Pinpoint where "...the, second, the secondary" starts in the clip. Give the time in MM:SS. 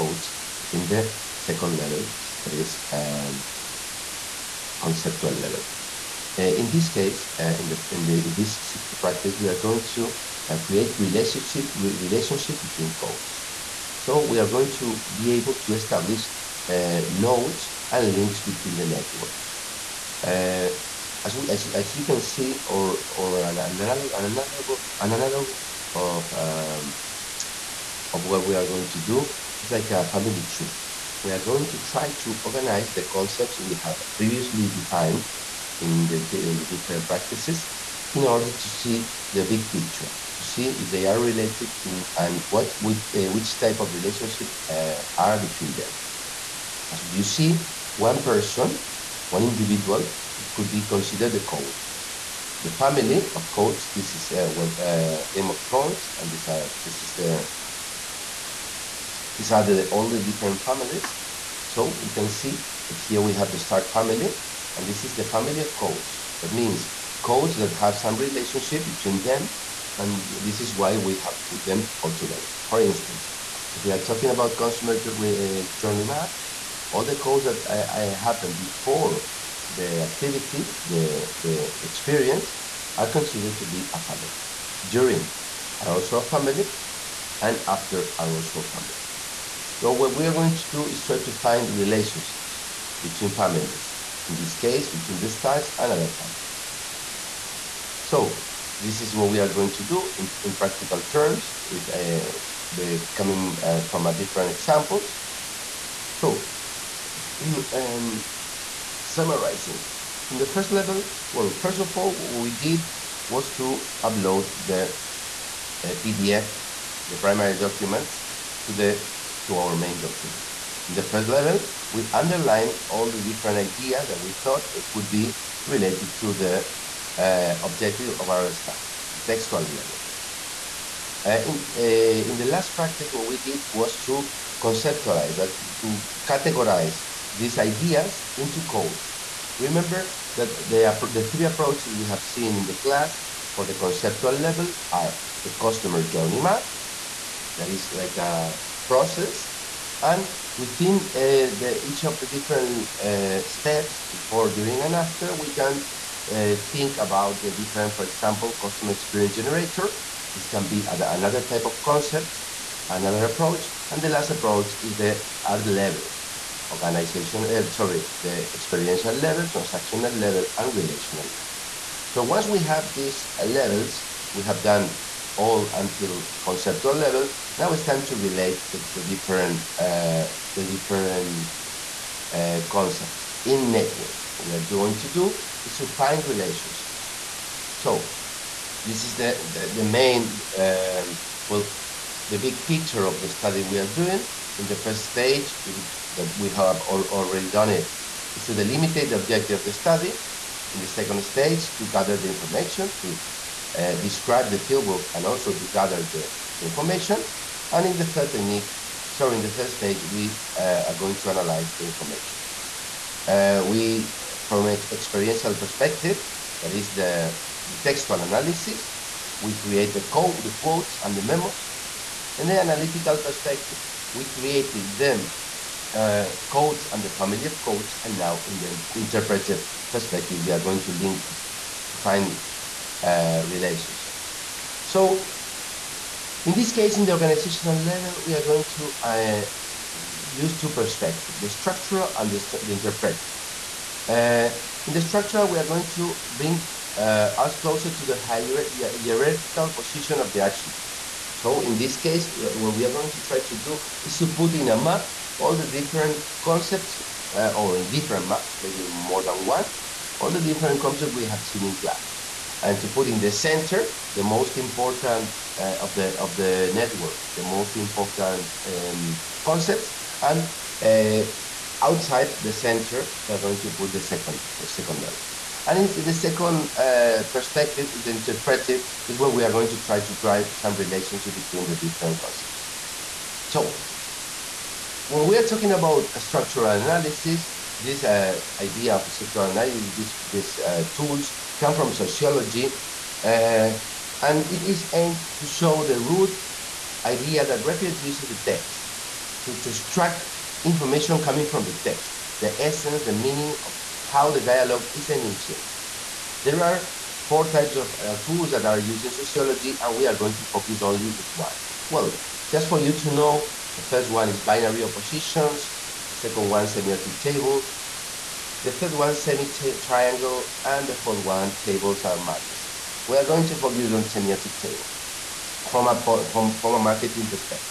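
04:33.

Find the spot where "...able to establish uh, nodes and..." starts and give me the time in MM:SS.
00:15.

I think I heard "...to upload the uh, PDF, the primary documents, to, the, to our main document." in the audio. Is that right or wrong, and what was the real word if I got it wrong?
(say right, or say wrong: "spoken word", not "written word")
right.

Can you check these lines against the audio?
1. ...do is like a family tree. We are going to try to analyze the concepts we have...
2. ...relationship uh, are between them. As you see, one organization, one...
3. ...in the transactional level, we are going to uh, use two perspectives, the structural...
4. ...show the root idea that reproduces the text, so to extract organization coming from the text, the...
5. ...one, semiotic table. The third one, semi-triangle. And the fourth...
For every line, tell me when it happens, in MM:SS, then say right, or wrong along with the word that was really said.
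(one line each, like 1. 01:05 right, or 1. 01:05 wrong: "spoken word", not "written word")
1. 00:29 wrong: "organize", not "analyze"
2. 00:43 wrong: "person", not "organization"
3. 03:56 wrong: "organizational", not "transactional"
4. 04:55 wrong: "information", not "organization"
5. 05:16 right.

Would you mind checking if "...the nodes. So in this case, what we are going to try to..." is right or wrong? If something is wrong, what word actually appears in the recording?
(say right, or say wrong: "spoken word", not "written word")
wrong: "attributes", not "nodes".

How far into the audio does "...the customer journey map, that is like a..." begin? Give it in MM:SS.
02:25.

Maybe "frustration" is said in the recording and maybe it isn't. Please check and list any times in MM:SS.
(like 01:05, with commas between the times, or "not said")
not said.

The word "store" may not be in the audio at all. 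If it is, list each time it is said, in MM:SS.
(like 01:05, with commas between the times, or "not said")
not said.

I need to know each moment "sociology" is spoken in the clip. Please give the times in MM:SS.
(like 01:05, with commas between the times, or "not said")
04:51, 05:09.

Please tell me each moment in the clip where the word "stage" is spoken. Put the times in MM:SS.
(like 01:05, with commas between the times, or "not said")
03:15, 03:21, 03:29.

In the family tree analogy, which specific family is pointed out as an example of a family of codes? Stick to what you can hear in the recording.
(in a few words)
Stark family.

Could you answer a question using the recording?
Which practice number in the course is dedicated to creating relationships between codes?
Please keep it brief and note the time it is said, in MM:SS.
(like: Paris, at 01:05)
6, at 00:08.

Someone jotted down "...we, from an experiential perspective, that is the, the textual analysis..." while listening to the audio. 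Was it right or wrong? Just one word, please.
right.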